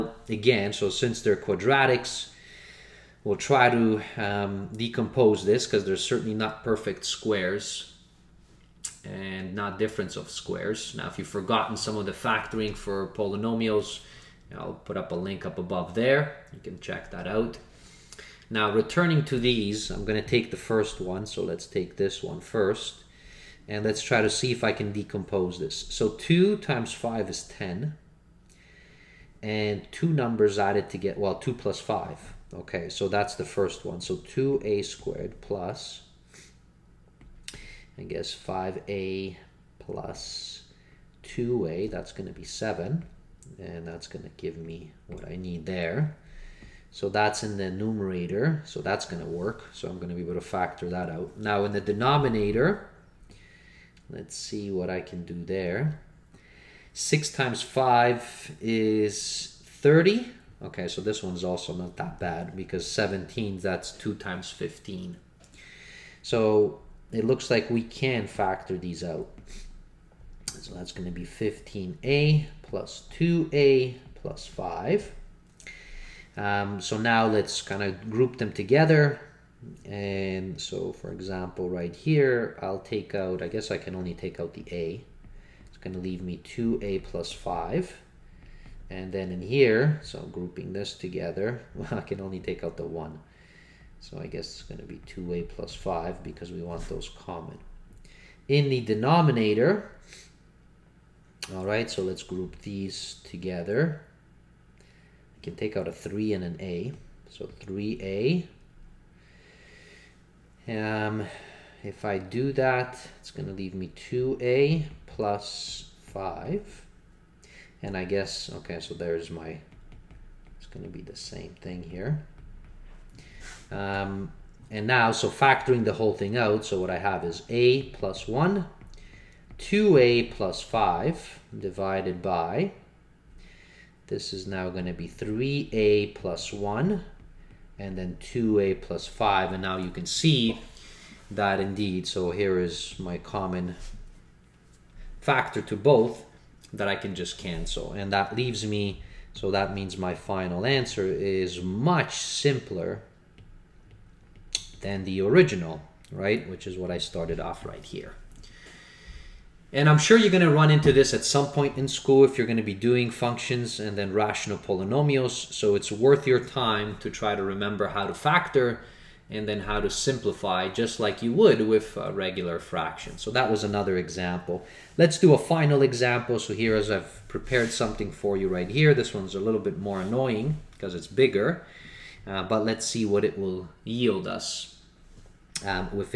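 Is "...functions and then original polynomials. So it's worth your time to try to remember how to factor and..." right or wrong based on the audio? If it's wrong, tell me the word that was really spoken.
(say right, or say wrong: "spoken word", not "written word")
wrong: "rational", not "original".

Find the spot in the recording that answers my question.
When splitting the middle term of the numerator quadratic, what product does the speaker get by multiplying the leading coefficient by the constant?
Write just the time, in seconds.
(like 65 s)
27 s.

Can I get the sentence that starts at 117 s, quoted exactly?
And I guess, okay, so there's my, it's going to be the same thing here.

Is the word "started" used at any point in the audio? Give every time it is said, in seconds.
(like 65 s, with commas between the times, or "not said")
156 s.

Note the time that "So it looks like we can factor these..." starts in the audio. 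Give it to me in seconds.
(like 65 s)
66 s.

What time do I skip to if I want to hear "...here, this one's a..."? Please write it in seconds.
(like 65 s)
178 s.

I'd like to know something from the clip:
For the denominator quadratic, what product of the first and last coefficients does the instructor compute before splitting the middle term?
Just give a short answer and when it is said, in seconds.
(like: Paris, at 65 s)
30, at 59 s.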